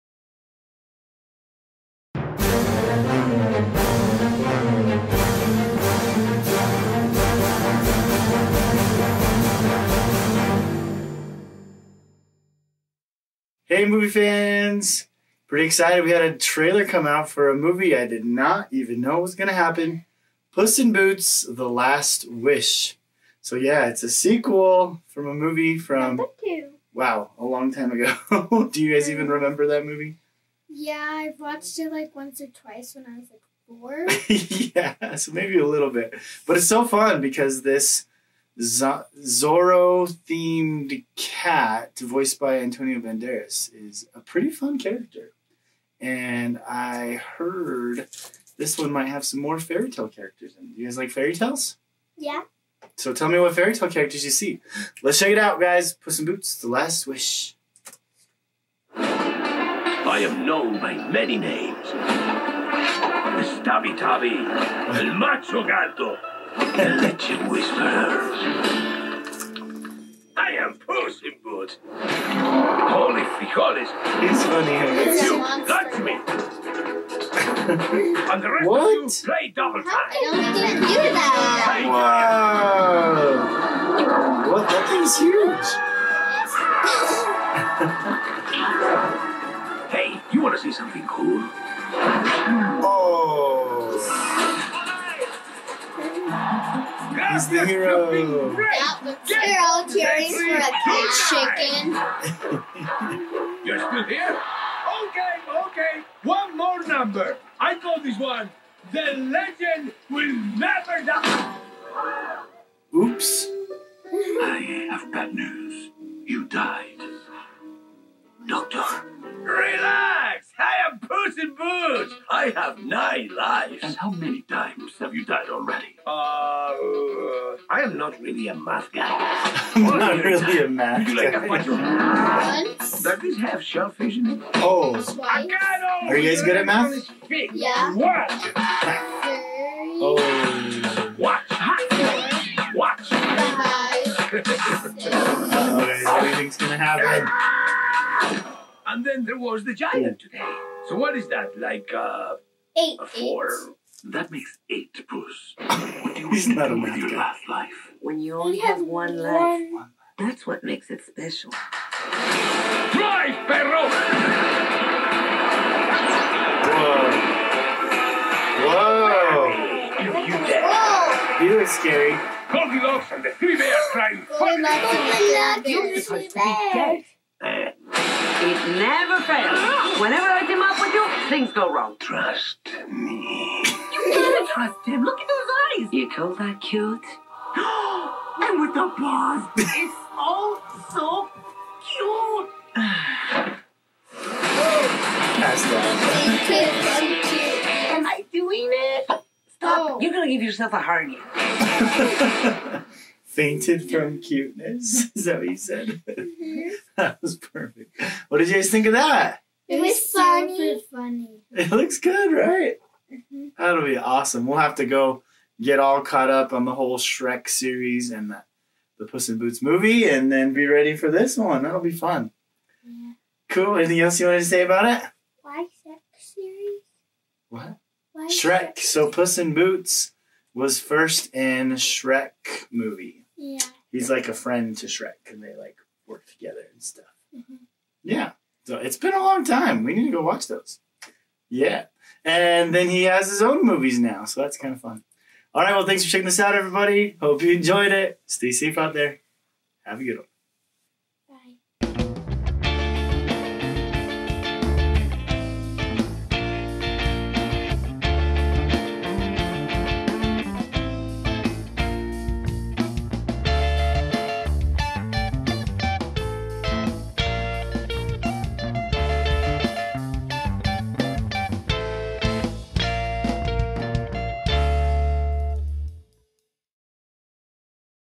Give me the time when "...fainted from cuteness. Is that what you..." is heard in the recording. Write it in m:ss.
3:23.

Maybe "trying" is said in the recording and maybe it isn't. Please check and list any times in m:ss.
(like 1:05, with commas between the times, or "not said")
2:53.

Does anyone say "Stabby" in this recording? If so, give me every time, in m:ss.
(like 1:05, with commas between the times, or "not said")
1:03.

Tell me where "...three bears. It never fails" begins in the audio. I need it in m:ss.
2:55.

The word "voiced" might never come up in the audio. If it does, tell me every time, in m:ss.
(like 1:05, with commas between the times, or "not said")
0:41.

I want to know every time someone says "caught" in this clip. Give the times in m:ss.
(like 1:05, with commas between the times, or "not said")
3:36.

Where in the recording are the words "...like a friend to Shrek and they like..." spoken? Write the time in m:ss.
3:54.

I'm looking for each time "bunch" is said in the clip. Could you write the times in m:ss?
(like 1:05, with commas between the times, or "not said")
2:11.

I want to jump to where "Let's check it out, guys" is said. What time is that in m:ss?
0:55.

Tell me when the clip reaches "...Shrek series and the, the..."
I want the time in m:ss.
3:36.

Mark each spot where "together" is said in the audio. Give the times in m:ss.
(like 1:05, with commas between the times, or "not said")
3:56.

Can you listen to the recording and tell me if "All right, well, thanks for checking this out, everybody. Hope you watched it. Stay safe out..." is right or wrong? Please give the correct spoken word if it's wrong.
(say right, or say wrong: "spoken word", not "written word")
wrong: "enjoyed", not "watched".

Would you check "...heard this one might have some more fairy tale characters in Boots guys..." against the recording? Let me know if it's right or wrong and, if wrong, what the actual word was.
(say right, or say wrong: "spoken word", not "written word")
wrong: "You", not "Boots".